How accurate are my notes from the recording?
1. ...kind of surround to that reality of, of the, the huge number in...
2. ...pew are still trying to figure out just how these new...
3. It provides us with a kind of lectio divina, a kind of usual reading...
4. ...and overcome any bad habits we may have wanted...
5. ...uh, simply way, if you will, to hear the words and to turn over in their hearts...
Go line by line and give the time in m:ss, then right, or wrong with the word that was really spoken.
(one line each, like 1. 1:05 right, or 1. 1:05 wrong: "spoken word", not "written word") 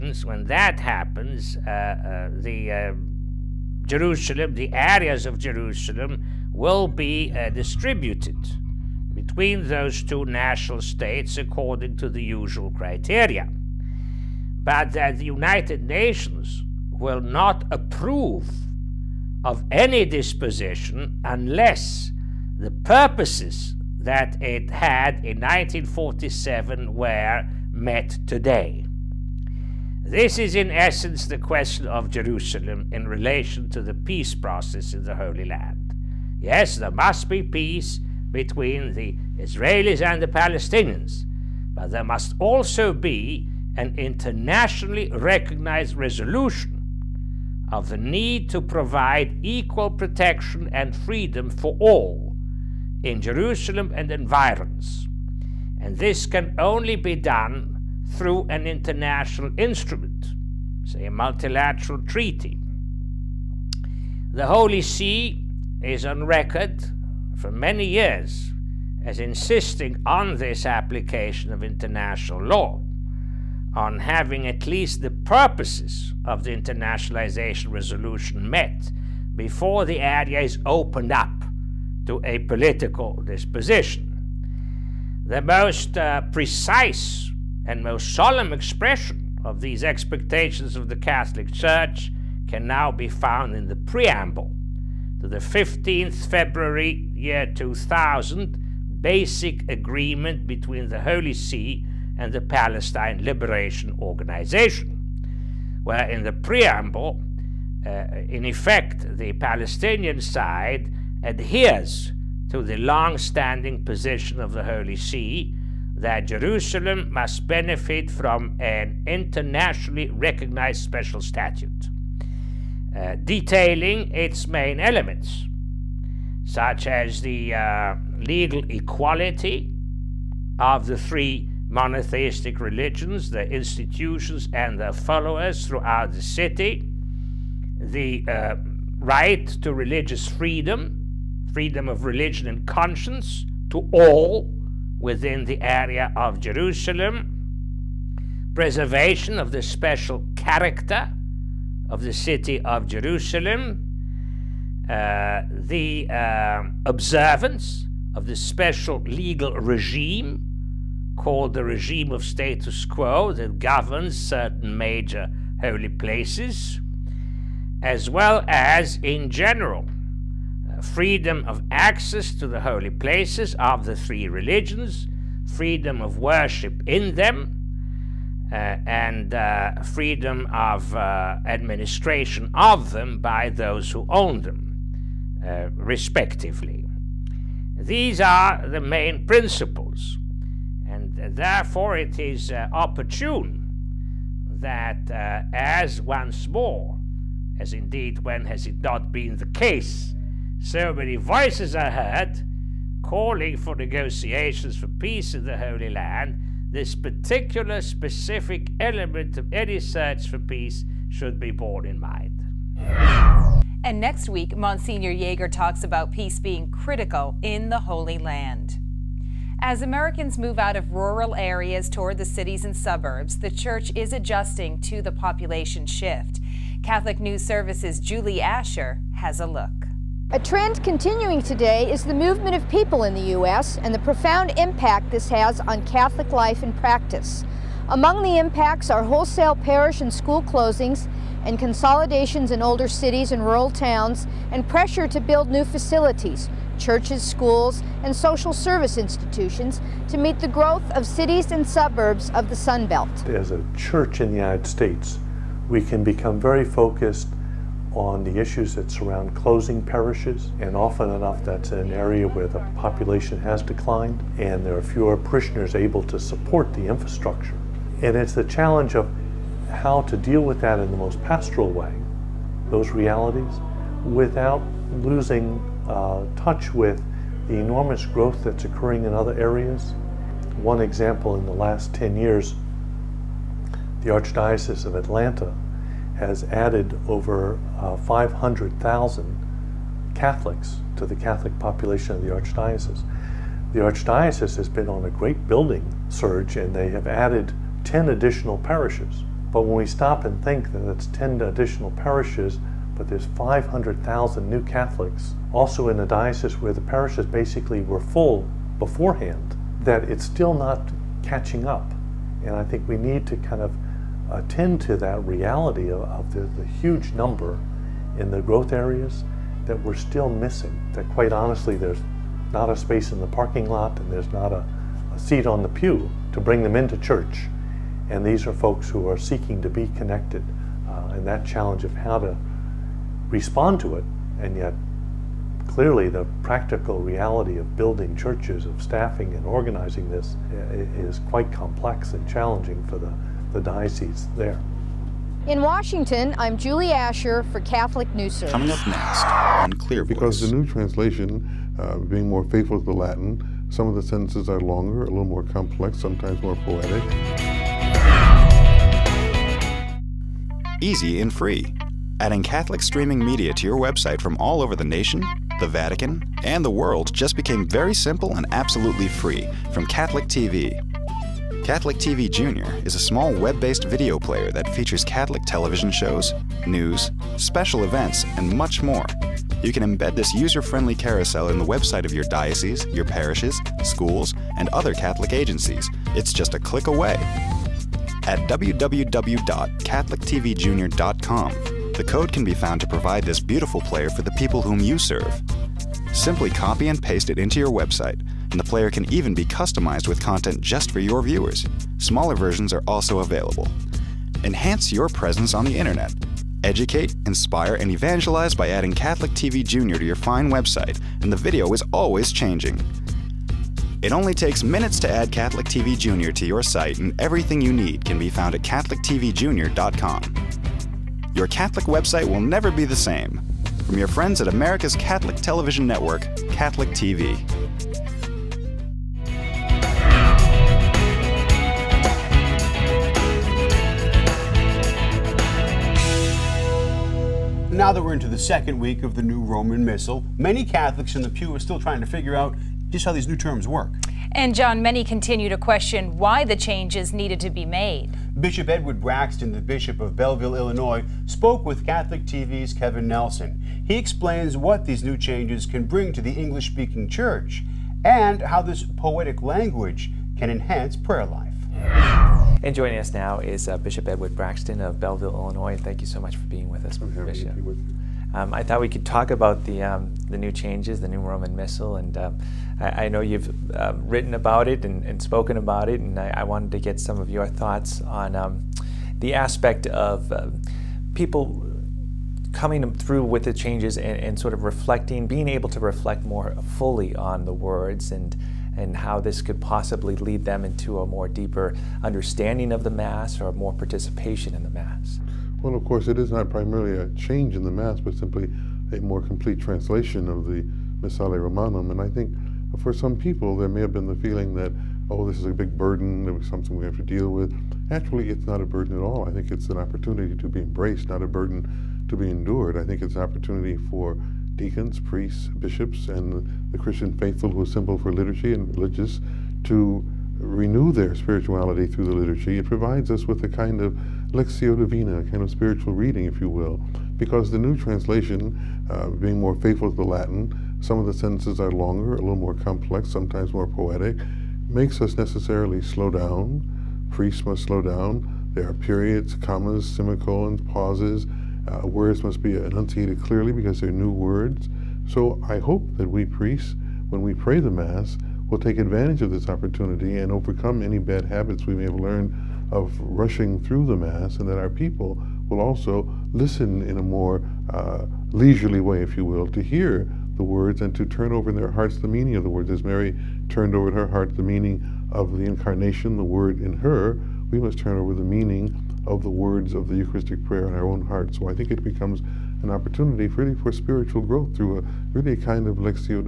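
1. 5:13 wrong: "attend", not "surround"
2. 7:21 right
3. 8:42 wrong: "spiritual", not "usual"
4. 9:10 wrong: "learned", not "wanted"
5. 9:17 wrong: "leisurely", not "simply".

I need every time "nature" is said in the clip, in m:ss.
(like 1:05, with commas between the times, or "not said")
not said.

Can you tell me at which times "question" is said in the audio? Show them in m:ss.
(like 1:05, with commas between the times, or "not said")
0:31, 7:25.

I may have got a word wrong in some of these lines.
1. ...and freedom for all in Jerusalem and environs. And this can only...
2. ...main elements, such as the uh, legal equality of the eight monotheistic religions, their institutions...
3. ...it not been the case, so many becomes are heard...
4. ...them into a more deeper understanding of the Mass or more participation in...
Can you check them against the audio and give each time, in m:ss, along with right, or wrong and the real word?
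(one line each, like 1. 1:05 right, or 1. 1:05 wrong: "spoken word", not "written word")
1. 0:50 right
2. 2:04 wrong: "three", not "eight"
3. 3:18 wrong: "voices", not "becomes"
4. 8:10 right.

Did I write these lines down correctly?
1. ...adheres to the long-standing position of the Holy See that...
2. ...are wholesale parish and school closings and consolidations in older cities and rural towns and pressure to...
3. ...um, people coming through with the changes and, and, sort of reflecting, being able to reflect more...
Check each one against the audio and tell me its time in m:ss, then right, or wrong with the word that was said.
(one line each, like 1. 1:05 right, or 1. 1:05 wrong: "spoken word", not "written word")
1. 1:51 right
2. 3:58 right
3. 8:00 right.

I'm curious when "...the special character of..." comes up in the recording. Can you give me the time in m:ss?
2:29.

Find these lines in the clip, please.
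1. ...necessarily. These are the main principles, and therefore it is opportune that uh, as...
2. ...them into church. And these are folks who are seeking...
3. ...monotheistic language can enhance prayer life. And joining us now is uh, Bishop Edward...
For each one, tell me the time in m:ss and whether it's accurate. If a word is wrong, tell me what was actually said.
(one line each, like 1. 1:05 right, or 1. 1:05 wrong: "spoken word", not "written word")
1. 3:05 wrong: "respectively", not "necessarily"
2. 5:26 right
3. 7:38 wrong: "poetic", not "monotheistic".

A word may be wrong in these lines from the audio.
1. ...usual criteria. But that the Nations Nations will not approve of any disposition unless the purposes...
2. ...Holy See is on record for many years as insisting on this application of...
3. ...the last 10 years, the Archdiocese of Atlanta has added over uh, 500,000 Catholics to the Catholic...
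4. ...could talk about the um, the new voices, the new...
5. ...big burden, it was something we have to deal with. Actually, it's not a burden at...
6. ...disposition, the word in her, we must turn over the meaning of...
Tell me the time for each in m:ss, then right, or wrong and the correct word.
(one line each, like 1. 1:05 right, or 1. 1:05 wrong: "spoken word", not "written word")
1. 0:12 wrong: "United", not "Nations"
2. 1:04 right
3. 4:41 right
4. 7:48 wrong: "changes", not "voices"
5. 8:25 right
6. 9:25 wrong: "incarnation", not "disposition".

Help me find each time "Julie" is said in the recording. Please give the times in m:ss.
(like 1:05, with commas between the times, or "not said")
3:47, 5:46.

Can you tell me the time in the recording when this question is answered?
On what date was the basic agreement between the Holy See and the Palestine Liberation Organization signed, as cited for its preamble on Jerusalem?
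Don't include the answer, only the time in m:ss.
1:35.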